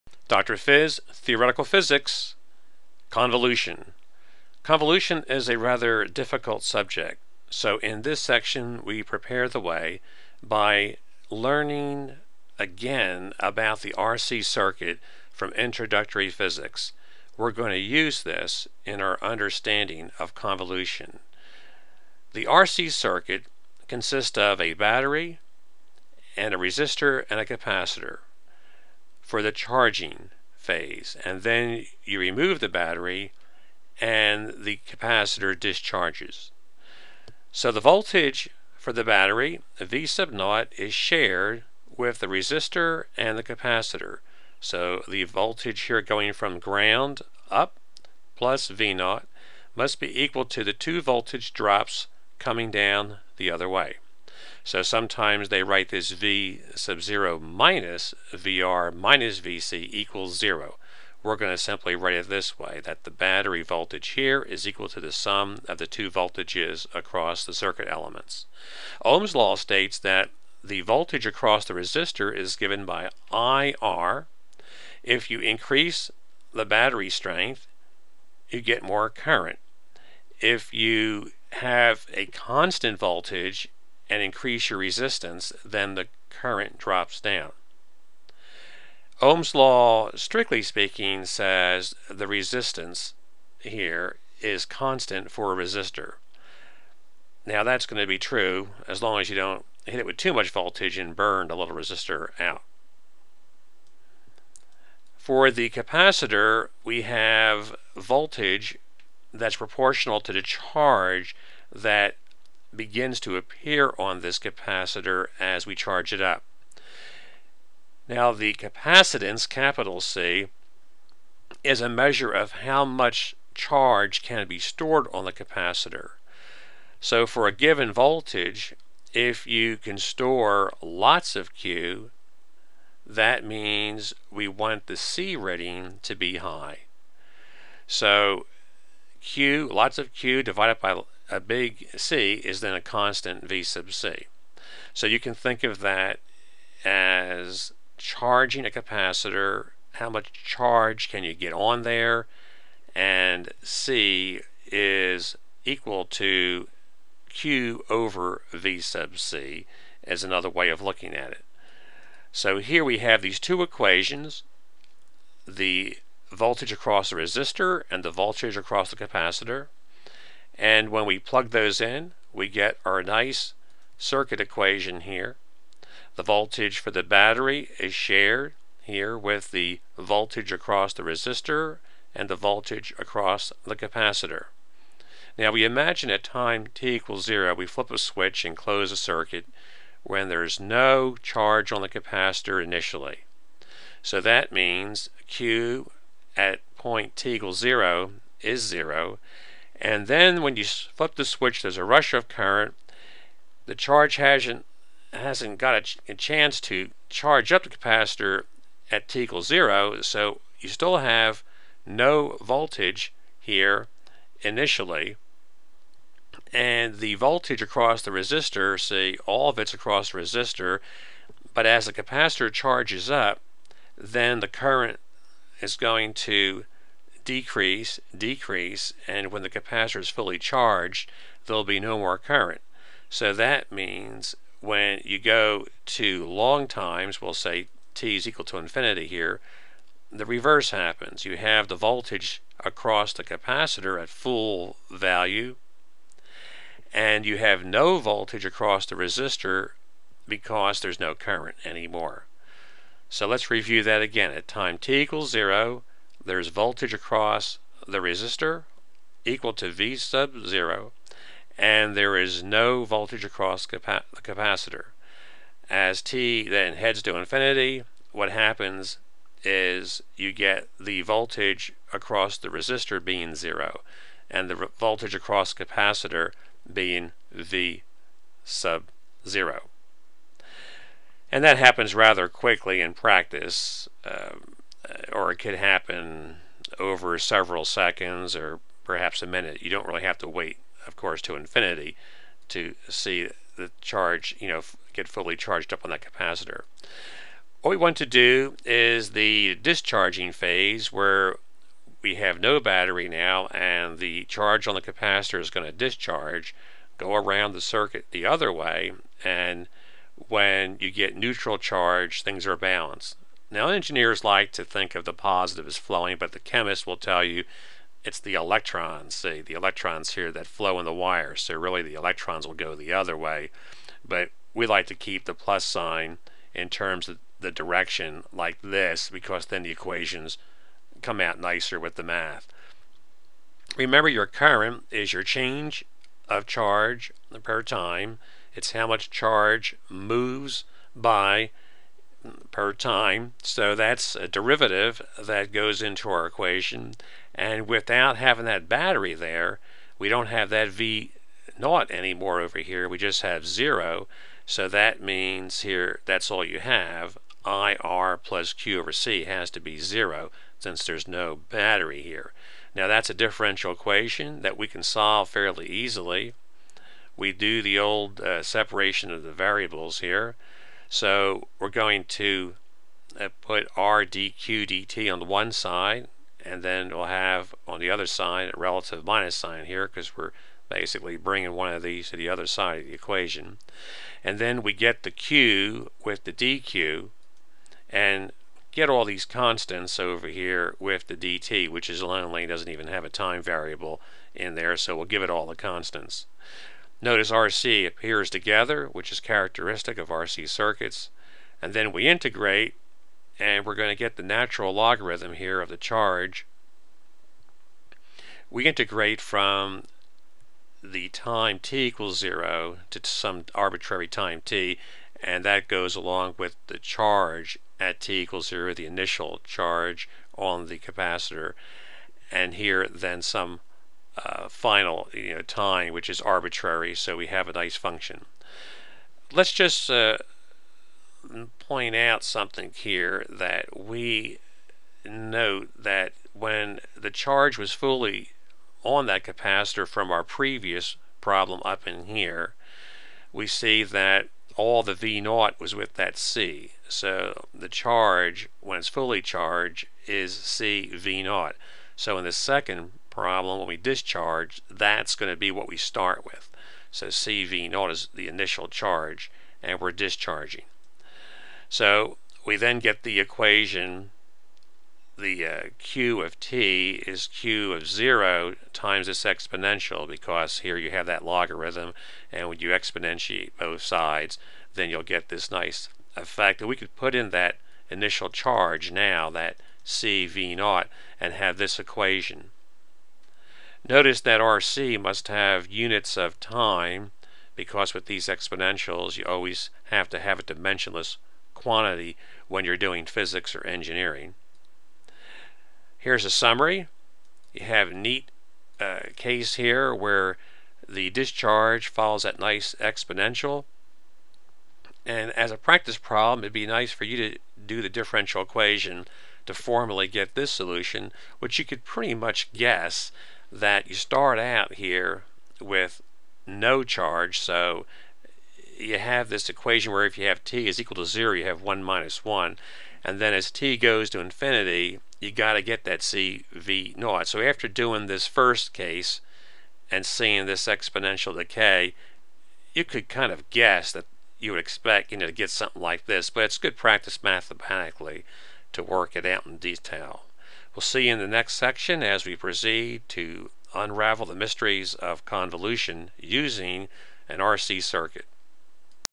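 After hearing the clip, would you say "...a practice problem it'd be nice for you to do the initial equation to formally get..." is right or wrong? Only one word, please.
wrong.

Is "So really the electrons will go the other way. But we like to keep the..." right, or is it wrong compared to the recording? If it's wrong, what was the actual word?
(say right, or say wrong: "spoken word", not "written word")
right.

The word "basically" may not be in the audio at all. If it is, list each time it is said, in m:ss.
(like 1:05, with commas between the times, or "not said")
6:20.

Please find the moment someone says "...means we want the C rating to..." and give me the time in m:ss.
2:13.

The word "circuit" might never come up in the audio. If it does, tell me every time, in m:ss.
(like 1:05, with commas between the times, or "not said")
0:14, 0:22, 1:07, 2:53, 3:08, 5:07, 6:40, 9:07.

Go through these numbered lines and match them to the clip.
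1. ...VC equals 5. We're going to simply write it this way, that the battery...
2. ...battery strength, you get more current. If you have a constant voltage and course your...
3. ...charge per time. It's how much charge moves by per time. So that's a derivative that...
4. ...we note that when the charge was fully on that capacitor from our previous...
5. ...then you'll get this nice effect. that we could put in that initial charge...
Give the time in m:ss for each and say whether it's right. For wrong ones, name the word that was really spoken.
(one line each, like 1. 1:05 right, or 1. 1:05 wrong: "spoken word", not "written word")
1. 0:59 wrong: "0", not "5"
2. 1:16 wrong: "increase", not "course"
3. 5:36 right
4. 7:13 right
5. 7:54 right.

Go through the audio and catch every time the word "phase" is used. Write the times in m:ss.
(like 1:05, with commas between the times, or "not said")
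0:30, 5:00.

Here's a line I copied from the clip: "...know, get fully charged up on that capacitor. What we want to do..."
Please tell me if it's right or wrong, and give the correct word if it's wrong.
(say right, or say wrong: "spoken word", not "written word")
right.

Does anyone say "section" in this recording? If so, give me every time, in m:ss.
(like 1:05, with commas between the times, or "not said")
0:08, 9:01.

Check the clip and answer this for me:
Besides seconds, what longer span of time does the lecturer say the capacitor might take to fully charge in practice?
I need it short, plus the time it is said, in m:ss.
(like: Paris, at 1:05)
A minute, at 4:48.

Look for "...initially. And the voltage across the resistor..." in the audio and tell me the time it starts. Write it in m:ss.
3:34.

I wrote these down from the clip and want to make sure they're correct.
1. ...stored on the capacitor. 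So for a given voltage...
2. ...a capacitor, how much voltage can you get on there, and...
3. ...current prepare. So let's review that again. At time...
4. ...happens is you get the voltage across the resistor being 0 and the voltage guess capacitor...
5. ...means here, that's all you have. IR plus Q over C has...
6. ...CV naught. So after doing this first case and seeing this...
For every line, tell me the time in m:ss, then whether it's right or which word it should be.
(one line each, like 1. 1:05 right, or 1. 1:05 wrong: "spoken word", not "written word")
1. 2:04 right
2. 2:28 wrong: "charge", not "voltage"
3. 4:11 wrong: "anymore", not "prepare"
4. 4:28 wrong: "across", not "guess"
5. 5:55 right
6. 8:45 right.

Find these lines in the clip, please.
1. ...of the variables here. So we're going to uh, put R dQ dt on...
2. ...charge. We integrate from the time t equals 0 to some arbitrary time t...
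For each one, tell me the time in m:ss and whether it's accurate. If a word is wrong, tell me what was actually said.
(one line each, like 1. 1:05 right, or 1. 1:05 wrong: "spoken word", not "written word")
1. 6:09 right
2. 6:45 right.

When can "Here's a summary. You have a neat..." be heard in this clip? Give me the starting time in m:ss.
8:15.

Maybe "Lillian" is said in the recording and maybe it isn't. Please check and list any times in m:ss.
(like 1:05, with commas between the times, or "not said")
not said.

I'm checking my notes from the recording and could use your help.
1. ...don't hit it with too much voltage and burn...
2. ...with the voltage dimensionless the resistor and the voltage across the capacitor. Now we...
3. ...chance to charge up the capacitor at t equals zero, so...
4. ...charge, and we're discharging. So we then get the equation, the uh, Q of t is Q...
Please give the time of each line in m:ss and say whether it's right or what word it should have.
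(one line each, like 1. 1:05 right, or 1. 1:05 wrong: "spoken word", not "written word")
1. 1:39 right
2. 2:59 wrong: "across", not "dimensionless"
3. 3:26 right
4. 7:38 right.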